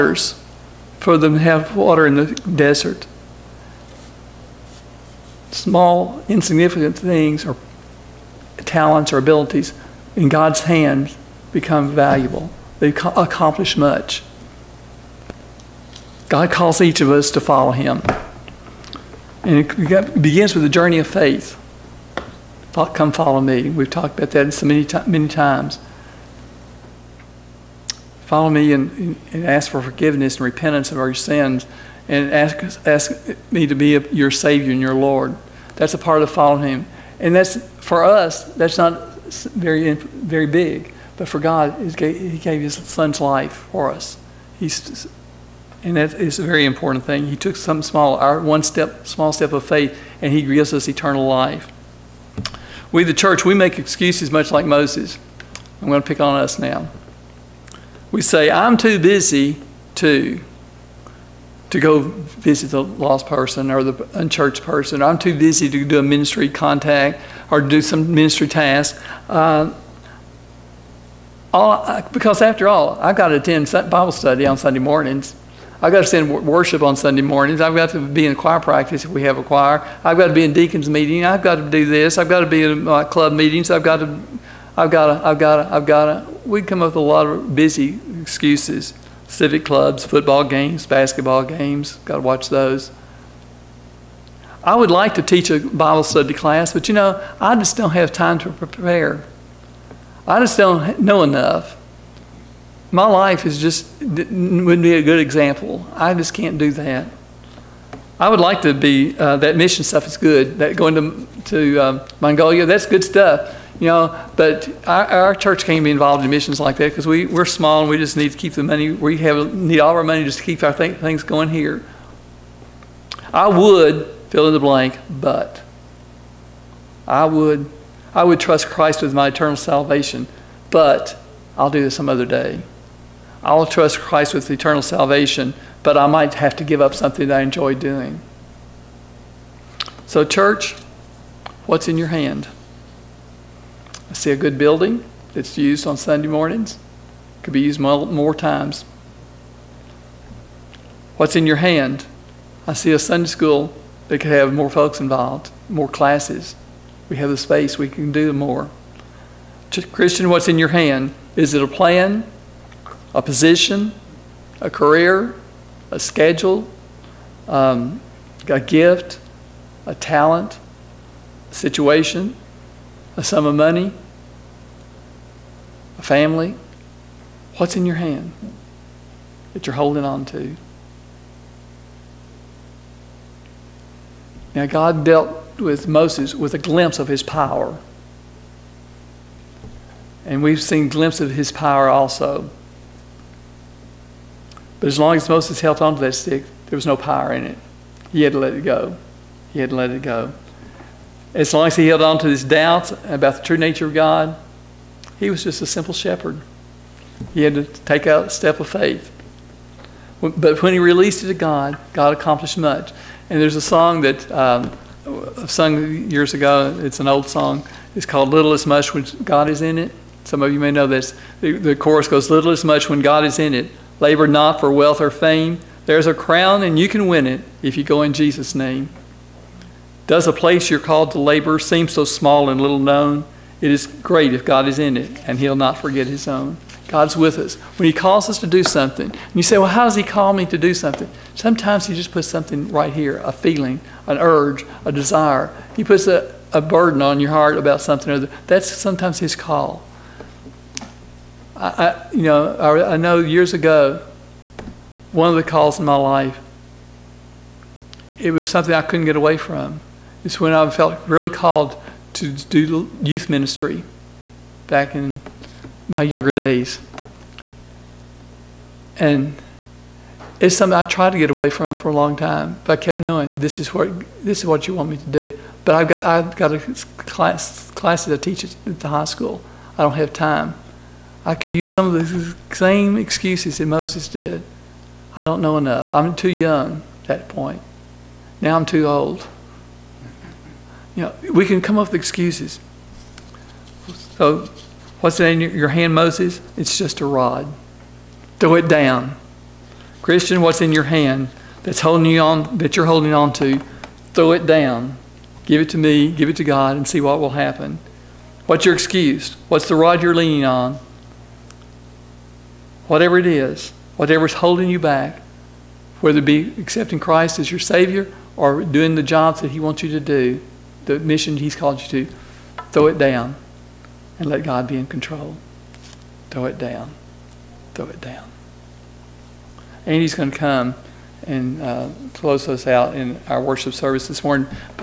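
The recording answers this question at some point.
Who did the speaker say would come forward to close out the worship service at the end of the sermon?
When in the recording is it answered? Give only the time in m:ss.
5:29.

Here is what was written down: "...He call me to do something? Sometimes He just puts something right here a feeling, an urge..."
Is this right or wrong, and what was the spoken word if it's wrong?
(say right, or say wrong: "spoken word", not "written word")
right.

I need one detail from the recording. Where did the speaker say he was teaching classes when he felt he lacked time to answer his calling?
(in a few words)
the high school.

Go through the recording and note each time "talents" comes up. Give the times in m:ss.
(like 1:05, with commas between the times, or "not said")
0:08, 2:49.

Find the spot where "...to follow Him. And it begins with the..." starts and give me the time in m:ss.
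0:17.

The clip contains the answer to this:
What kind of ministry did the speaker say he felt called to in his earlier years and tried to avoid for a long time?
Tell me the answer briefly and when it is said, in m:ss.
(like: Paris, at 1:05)
youth ministry, at 4:23.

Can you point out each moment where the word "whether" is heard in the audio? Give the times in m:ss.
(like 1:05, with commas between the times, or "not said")
5:16.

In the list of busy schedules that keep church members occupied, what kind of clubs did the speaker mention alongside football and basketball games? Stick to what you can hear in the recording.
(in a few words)
civic clubs.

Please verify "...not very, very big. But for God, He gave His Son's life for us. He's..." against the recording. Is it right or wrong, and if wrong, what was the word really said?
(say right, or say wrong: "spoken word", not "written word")
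right.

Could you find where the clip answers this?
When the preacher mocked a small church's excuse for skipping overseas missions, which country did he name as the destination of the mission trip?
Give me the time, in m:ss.
1:52.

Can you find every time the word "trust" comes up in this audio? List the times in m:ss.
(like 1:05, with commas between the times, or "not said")
2:08, 2:13.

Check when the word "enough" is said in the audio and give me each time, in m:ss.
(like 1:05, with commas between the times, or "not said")
1:41, 4:45.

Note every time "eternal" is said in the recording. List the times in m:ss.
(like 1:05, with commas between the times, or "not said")
0:50, 2:09, 2:14.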